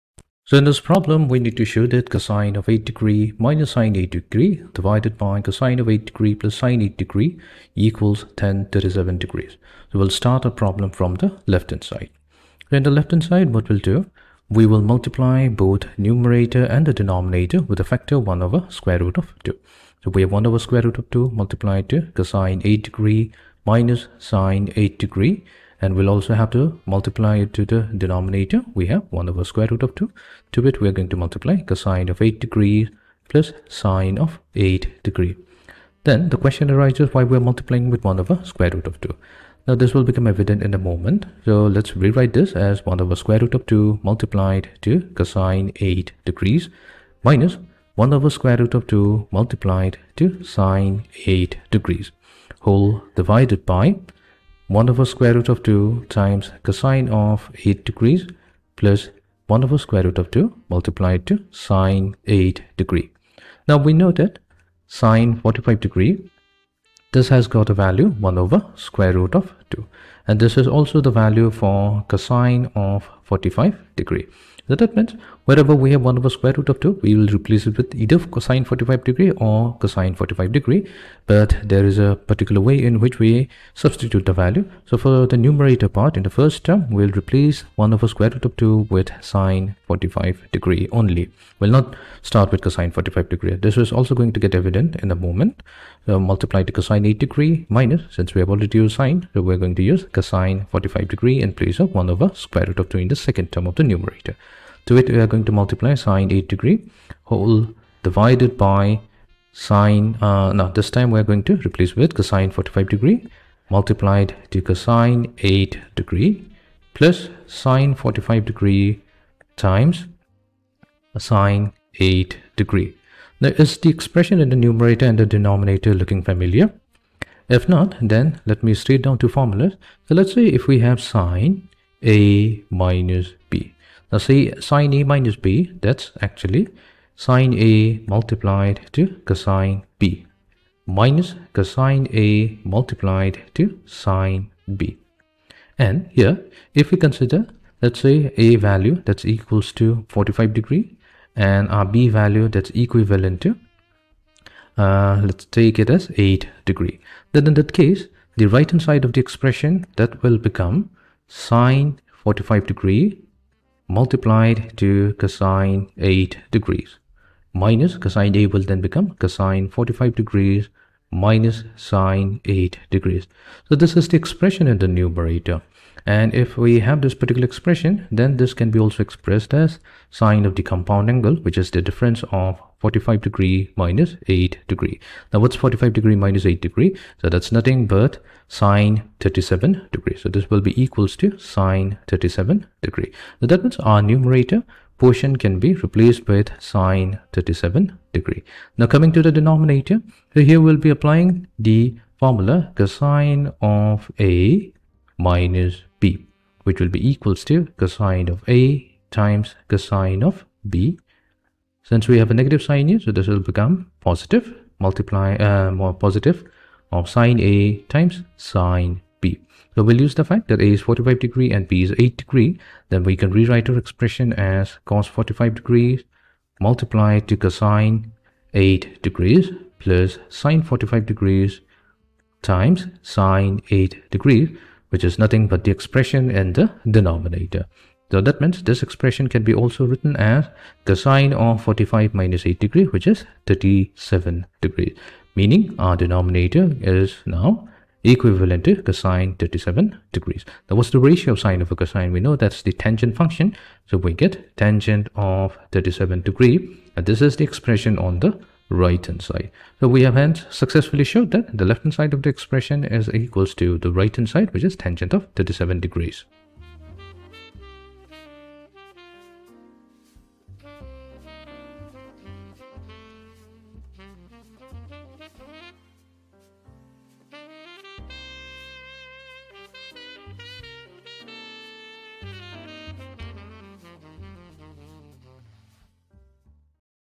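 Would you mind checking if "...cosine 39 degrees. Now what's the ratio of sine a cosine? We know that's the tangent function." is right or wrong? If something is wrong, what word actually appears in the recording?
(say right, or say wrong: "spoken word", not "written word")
wrong: "37", not "39".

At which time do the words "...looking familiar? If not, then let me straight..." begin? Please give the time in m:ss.
2:06.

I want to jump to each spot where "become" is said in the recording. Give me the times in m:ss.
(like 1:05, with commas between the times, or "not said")
0:40, 2:40, 2:48, 3:33.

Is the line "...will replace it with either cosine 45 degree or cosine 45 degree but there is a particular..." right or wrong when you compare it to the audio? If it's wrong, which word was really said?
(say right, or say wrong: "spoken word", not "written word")
right.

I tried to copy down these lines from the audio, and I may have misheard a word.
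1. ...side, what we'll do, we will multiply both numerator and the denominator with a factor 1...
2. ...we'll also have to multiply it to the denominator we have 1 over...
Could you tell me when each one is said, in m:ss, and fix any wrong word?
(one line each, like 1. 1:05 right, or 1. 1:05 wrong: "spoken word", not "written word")
1. 0:13 right
2. 0:25 right.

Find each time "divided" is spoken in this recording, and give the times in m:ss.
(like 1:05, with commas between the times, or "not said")
0:04, 0:53, 1:48.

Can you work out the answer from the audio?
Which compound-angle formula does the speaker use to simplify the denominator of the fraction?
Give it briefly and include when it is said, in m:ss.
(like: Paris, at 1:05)
cosine of a minus b, at 3:22.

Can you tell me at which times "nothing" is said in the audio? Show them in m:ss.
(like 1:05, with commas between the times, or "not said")
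3:07, 3:55.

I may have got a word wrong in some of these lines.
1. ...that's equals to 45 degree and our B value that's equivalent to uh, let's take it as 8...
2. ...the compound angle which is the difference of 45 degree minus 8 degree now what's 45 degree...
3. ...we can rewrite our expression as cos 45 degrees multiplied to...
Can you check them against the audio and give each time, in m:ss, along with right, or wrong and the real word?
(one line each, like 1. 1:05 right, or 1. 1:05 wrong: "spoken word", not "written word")
1. 2:29 right
2. 3:00 right
3. 3:43 right.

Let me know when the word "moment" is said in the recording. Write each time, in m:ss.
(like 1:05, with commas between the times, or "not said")
0:40, 1:35.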